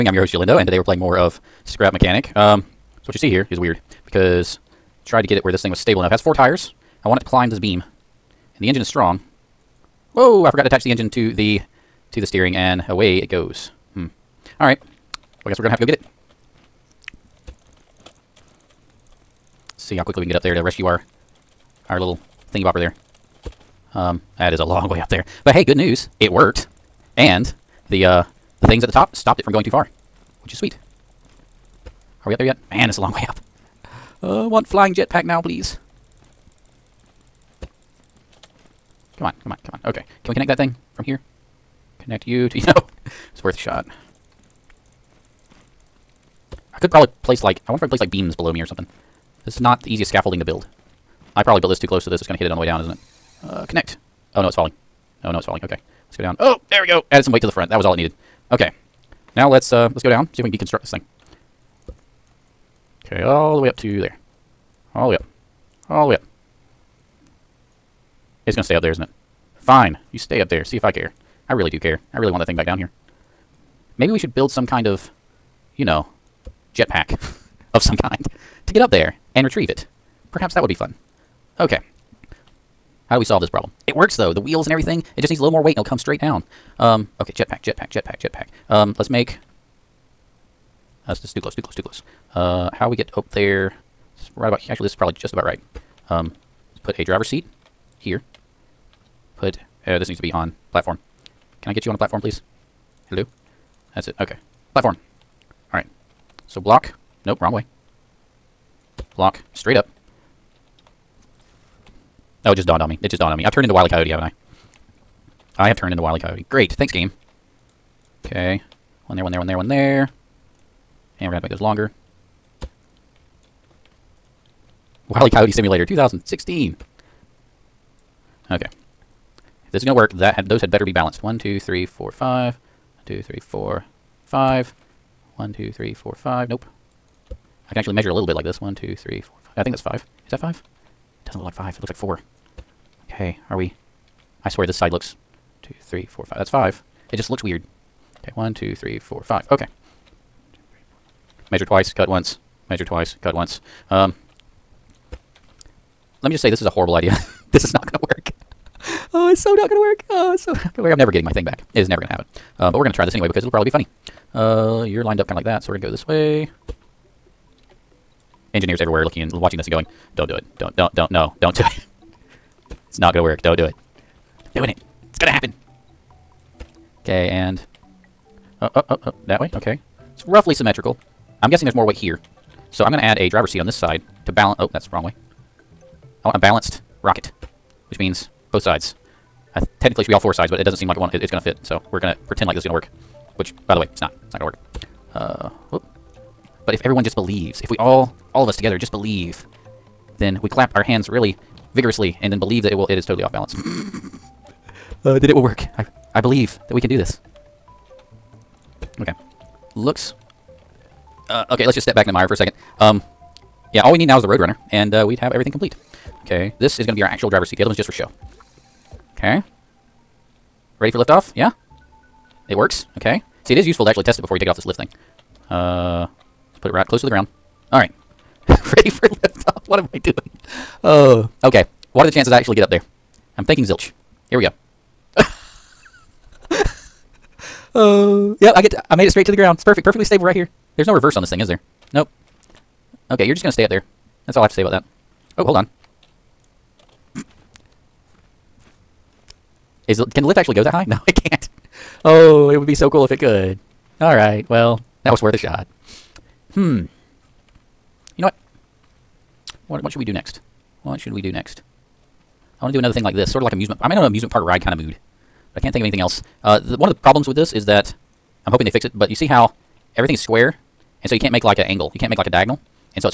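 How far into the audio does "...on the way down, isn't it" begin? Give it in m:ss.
0:52.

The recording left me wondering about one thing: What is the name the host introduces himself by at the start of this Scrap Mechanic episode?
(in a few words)
Jalindo.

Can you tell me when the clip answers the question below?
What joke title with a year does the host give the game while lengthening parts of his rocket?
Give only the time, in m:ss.
2:05.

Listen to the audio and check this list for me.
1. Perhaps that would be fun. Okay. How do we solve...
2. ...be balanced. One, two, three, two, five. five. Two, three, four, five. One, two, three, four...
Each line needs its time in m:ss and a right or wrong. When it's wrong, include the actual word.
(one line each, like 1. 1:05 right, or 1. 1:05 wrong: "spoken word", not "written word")
1. 1:20 right
2. 2:10 wrong: "four", not "two".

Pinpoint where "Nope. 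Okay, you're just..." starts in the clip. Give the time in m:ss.
4:01.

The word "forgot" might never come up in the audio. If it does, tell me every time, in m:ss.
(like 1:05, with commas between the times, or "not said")
0:10.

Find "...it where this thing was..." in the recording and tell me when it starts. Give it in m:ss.
0:05.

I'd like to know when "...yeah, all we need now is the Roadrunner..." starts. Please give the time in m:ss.
3:33.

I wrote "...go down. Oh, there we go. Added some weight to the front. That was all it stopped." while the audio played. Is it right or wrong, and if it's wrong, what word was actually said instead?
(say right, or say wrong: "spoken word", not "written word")
wrong: "needed", not "stopped".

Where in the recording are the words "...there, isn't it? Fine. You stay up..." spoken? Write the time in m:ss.
1:08.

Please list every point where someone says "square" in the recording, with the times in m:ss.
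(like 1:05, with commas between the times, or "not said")
4:30.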